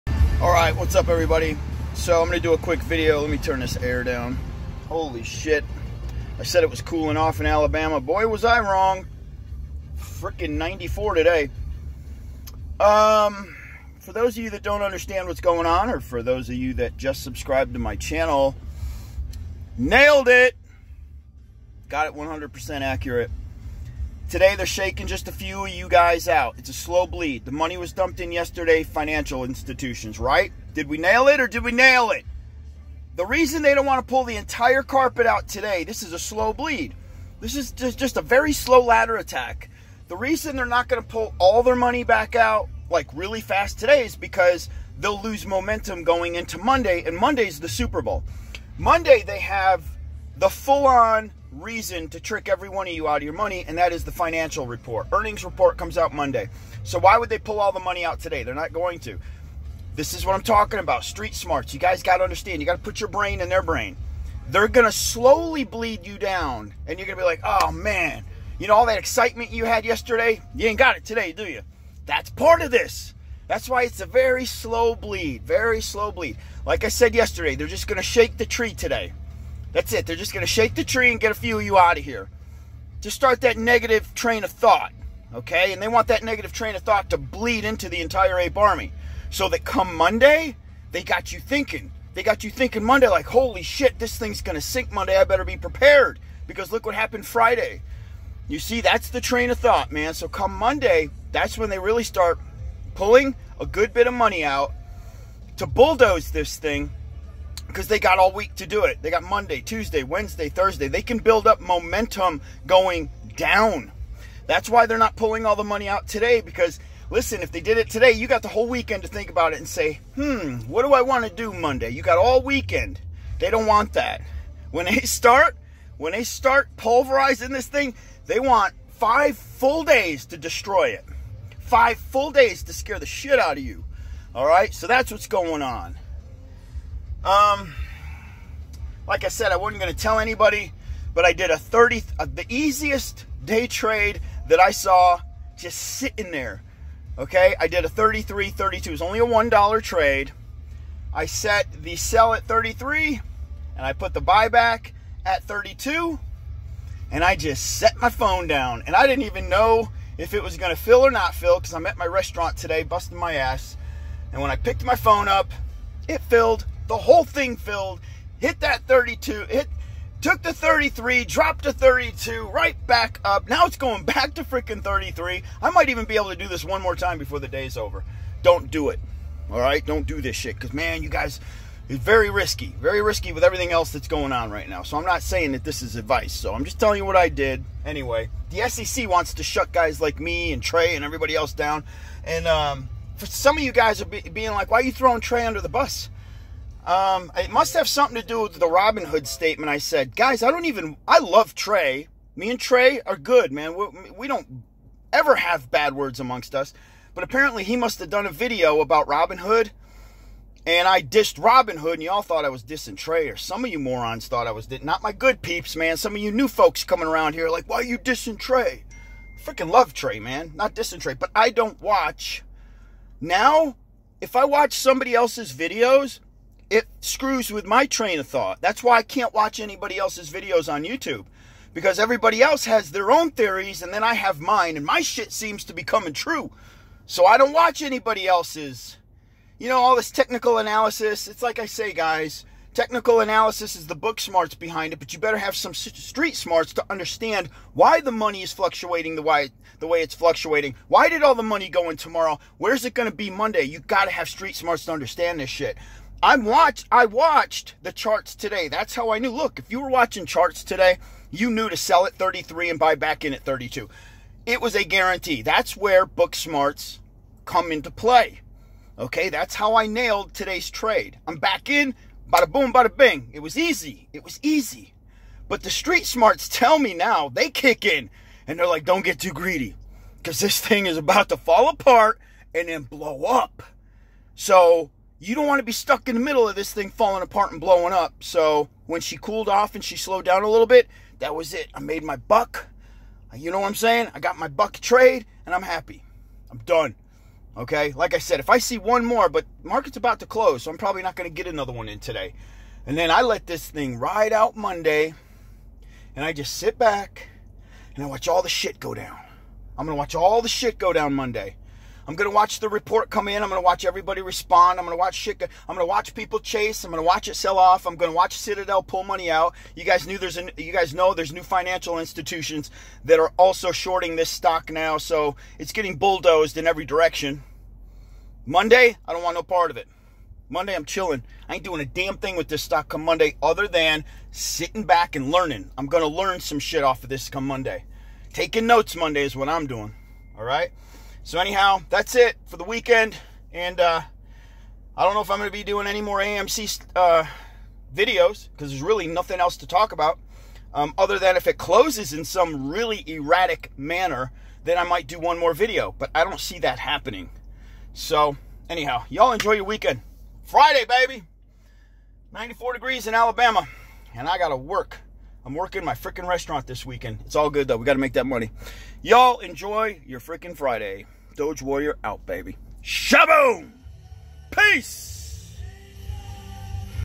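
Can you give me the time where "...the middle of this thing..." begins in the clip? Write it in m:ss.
4:46.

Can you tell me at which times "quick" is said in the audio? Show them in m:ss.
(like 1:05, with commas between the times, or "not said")
0:02.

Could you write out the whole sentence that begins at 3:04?
So I'm not saying that this is advice.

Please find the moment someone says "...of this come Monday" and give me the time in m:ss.
5:37.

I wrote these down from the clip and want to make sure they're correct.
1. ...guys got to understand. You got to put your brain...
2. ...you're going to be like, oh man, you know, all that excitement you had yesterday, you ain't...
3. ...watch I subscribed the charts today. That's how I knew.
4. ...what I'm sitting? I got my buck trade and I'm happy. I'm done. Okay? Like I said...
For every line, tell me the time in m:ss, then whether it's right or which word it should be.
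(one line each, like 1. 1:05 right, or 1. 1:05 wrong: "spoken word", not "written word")
1. 1:01 right
2. 1:06 right
3. 4:16 wrong: "watched", not "subscribed"
4. 4:53 wrong: "saying", not "sitting".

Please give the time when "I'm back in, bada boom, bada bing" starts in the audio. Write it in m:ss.
4:31.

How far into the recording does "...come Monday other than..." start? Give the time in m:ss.
5:32.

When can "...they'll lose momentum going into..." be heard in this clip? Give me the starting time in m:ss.
0:44.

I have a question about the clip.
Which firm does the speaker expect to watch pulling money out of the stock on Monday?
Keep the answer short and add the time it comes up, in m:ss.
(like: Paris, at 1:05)
Citadel, at 5:18.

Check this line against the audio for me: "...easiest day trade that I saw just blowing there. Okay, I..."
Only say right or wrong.
wrong.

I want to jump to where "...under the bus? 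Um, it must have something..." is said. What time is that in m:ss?
3:15.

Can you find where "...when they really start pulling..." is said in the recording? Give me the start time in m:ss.
1:41.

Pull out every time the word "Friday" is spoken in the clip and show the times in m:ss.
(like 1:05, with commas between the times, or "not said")
1:37, 6:00, 6:10.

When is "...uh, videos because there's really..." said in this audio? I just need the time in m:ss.
5:46.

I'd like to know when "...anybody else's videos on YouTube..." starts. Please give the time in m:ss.
3:49.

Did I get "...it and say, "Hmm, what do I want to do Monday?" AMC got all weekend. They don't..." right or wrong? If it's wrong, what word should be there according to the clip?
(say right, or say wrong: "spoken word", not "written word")
wrong: "You", not "AMC".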